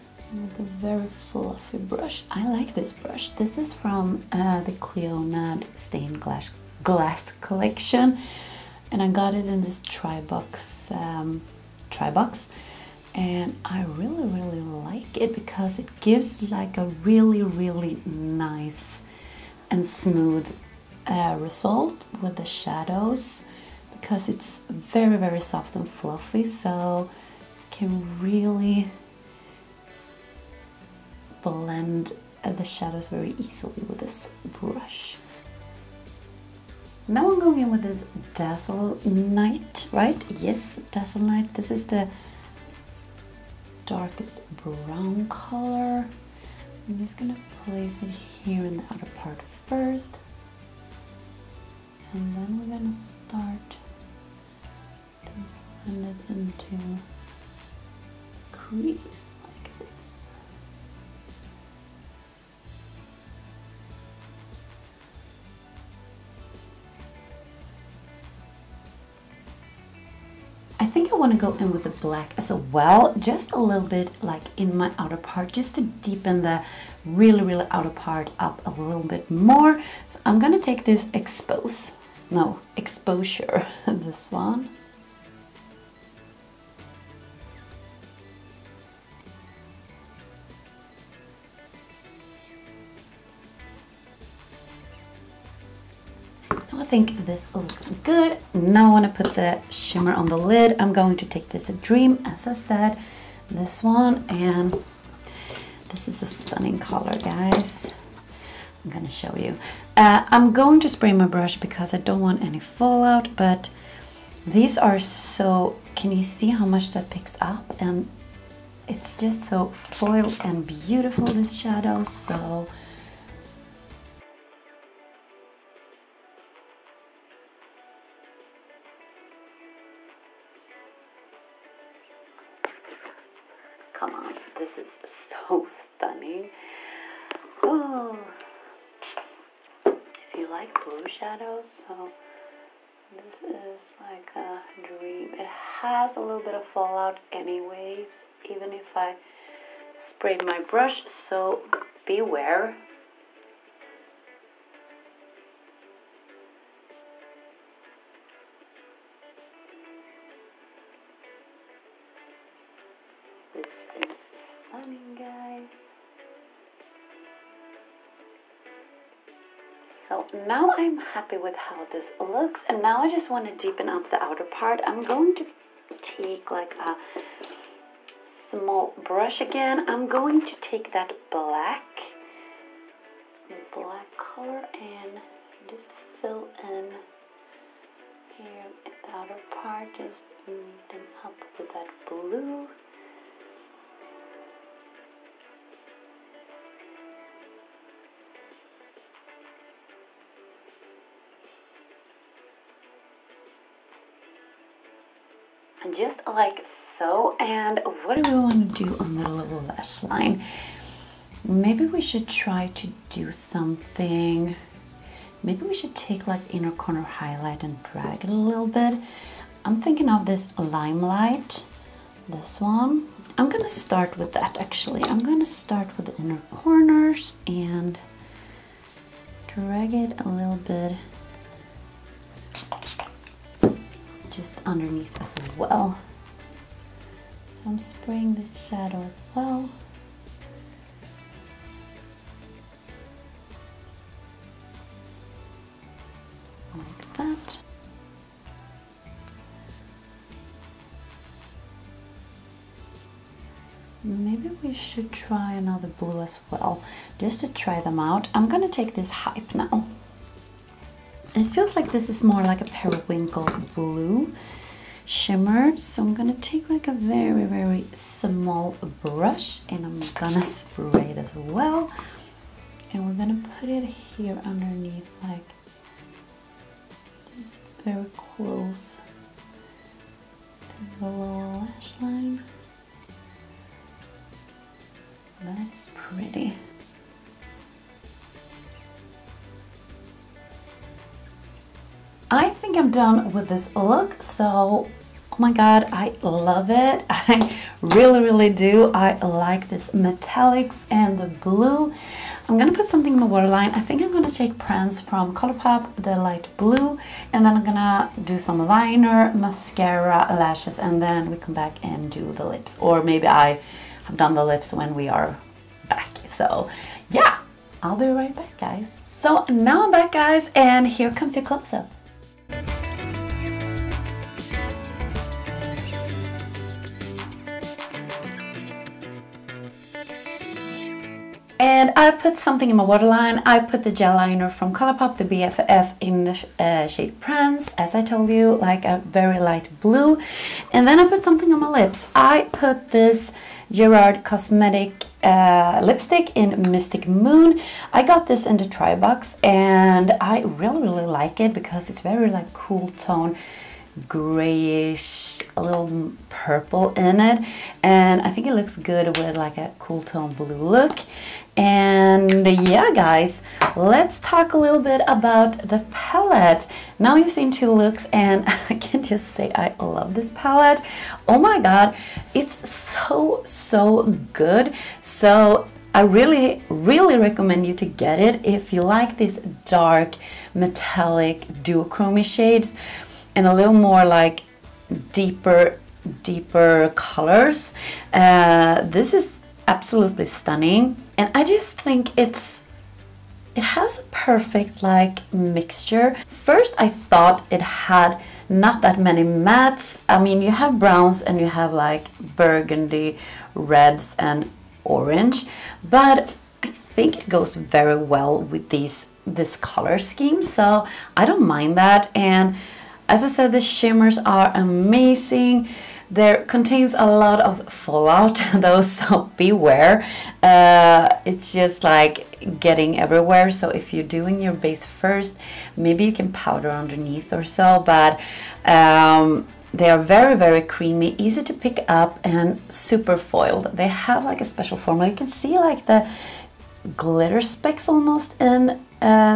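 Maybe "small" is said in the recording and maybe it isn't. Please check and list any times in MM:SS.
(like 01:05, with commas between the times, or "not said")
02:58, 04:27.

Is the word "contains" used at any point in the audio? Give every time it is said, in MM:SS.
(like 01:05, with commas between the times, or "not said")
06:56.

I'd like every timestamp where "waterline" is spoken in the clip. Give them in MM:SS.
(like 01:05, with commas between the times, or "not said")
05:03, 05:32.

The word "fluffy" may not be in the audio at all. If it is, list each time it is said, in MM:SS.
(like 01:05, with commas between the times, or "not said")
00:01, 00:25.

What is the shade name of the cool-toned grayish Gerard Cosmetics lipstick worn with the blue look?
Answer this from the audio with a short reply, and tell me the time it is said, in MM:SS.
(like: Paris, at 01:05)
Mystic Moon, at 05:46.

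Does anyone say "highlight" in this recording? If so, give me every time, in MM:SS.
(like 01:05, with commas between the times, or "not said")
03:37.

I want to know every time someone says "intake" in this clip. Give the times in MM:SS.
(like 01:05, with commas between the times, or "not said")
not said.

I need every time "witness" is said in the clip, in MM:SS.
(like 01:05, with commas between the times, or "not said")
not said.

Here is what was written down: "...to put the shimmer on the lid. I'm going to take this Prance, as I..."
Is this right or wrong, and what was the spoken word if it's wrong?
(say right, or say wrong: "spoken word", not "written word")
wrong: "Dream", not "Prance".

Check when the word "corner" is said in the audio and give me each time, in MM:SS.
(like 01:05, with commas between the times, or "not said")
03:36, 03:46.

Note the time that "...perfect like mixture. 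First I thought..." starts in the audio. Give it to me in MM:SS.
06:34.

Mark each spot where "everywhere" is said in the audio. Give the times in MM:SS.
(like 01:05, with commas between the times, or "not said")
07:02.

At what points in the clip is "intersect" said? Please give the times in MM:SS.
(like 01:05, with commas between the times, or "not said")
not said.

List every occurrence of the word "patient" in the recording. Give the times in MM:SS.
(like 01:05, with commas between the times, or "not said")
not said.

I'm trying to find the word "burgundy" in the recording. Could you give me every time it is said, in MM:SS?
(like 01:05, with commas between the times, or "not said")
06:42.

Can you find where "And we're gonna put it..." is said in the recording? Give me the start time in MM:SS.
04:32.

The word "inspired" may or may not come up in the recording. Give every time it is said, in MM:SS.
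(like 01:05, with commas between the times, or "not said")
not said.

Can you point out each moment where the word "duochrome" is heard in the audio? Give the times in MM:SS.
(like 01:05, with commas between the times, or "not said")
06:21.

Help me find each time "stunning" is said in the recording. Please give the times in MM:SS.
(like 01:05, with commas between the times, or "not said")
01:46, 02:15, 06:30.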